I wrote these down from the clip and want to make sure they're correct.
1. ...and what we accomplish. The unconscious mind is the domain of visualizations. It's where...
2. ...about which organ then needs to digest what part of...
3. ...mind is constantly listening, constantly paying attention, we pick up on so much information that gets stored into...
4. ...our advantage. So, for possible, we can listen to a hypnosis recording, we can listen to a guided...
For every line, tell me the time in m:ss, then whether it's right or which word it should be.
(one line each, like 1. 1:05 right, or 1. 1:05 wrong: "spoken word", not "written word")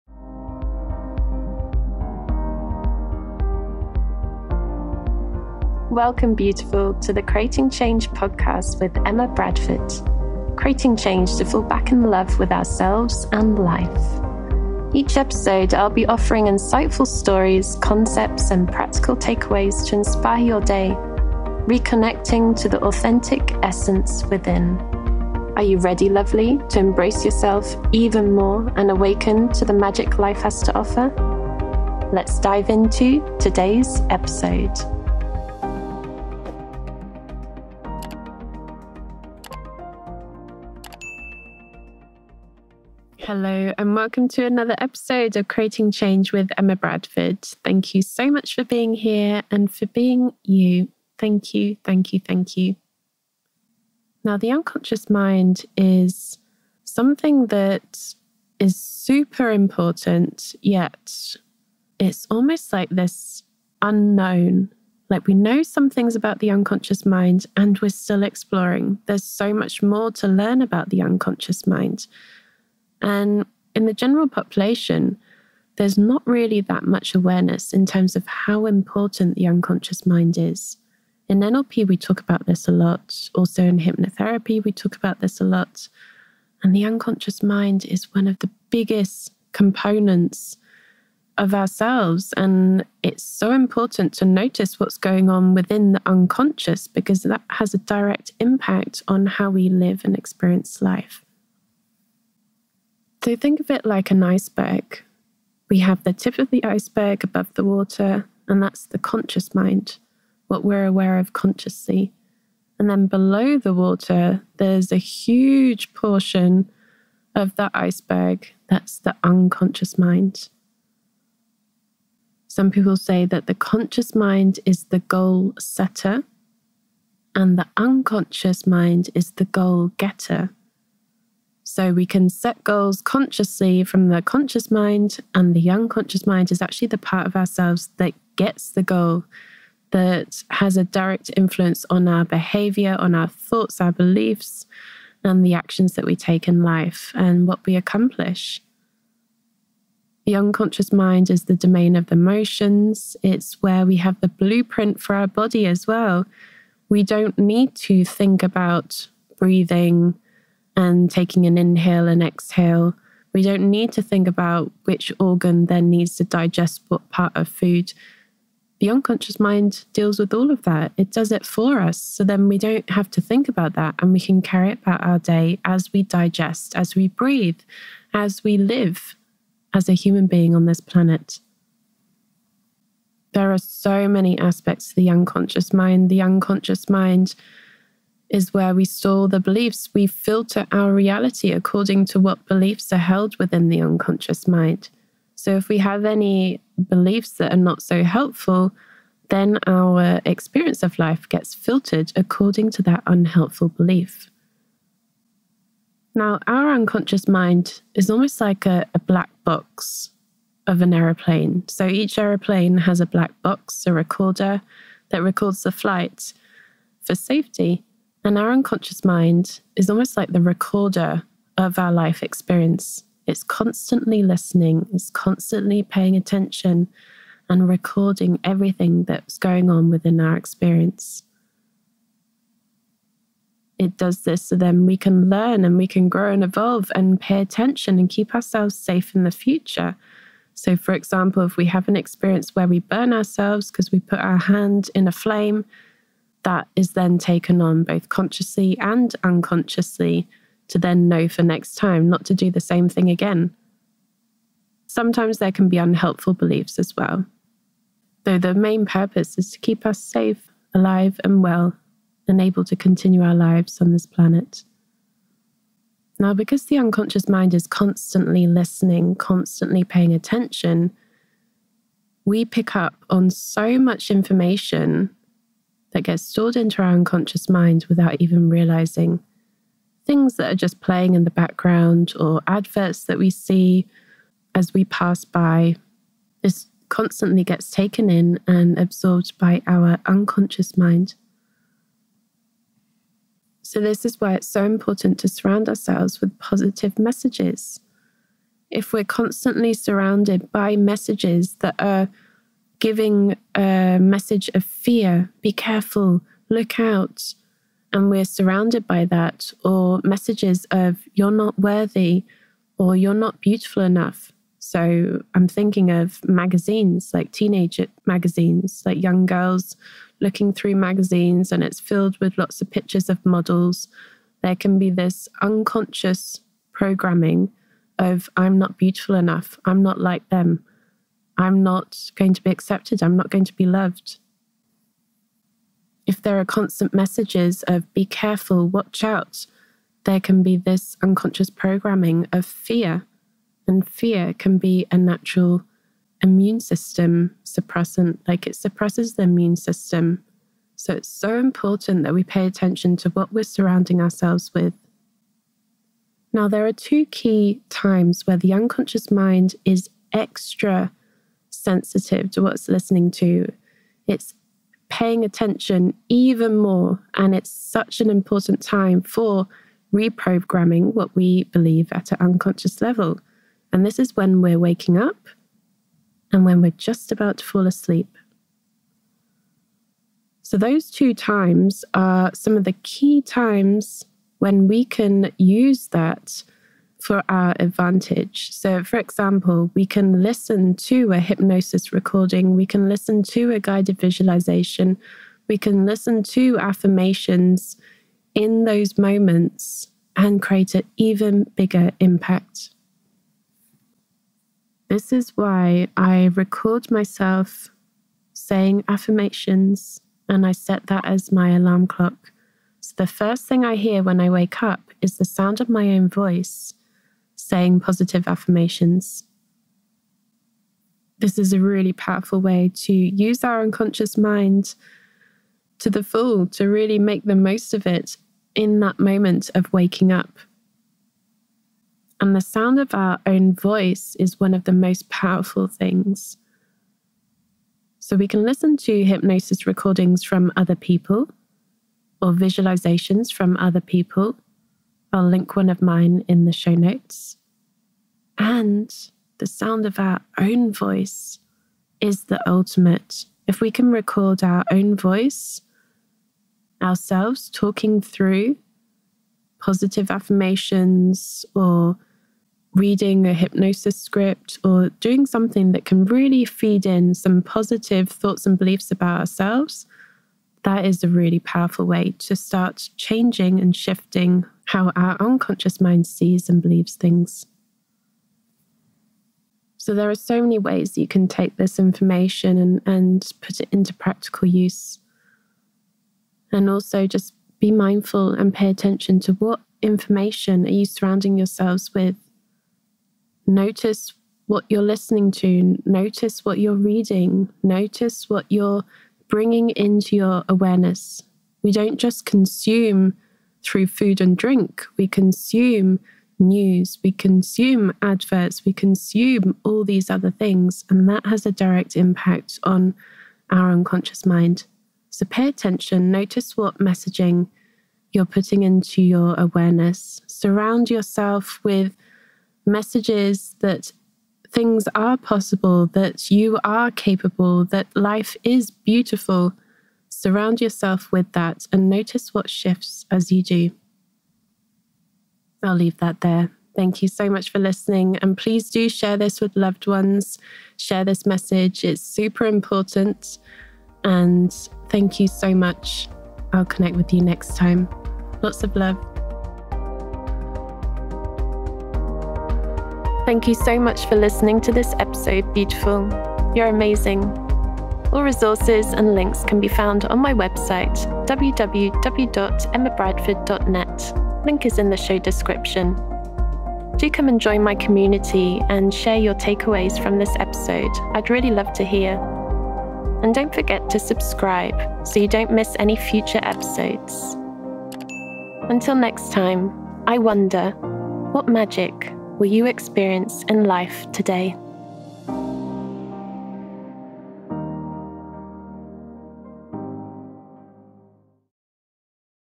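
1. 2:27 wrong: "emotions", not "visualizations"
2. 2:44 right
3. 4:27 right
4. 6:27 wrong: "example", not "possible".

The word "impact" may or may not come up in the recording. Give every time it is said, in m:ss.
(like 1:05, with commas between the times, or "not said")
1:38, 6:41, 8:31.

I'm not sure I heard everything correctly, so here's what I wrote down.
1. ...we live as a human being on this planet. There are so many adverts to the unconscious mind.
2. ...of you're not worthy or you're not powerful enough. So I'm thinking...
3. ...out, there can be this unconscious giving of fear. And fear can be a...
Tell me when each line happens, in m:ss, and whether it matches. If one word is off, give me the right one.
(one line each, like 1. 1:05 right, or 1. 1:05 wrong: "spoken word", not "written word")
1. 2:58 wrong: "aspects", not "adverts"
2. 5:10 wrong: "beautiful", not "powerful"
3. 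5:39 wrong: "programming", not "giving".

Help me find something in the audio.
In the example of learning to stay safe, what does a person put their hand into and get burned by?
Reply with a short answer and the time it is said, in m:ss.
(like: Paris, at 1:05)
A flame, at 4:05.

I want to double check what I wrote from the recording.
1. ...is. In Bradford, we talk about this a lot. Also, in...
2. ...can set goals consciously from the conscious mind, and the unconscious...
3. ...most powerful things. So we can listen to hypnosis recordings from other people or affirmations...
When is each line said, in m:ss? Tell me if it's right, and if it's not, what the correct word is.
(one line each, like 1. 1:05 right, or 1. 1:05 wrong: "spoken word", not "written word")
1. 1:20 wrong: "NLP", not "Bradford"
2. 2:12 right
3. 7:14 wrong: "visualizations", not "affirmations".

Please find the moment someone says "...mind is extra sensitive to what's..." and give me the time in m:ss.
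5:59.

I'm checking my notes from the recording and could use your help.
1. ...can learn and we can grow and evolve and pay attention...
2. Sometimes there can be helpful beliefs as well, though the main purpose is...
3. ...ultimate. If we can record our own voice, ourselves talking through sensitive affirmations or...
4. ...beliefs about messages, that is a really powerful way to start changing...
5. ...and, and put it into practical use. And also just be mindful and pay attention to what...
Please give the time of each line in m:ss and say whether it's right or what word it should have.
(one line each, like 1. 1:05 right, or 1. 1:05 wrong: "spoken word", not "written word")
1. 3:54 right
2. 4:14 wrong: "unhelpful", not "helpful"
3. 7:32 wrong: "positive", not "sensitive"
4. 7:48 wrong: "ourselves", not "messages"
5. 8:02 right.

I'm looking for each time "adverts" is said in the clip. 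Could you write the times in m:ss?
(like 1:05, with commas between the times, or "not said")
4:42, 8:28.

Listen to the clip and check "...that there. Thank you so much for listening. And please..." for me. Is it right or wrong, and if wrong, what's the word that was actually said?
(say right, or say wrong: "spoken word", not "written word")
right.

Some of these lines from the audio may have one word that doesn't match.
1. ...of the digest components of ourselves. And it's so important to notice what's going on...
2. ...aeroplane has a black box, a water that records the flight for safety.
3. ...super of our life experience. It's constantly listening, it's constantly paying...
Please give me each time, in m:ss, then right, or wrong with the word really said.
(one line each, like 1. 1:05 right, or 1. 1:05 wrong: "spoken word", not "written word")
1. 1:28 wrong: "biggest", not "digest"
2. 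3:32 wrong: "recorder", not "water"
3. 3:40 wrong: "recorder", not "super".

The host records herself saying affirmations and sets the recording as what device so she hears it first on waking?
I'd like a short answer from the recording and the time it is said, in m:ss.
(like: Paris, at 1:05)
Alarm clock, at 6:51.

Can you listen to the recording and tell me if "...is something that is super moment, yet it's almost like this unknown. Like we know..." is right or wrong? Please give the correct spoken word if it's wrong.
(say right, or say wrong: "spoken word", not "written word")
wrong: "important", not "moment".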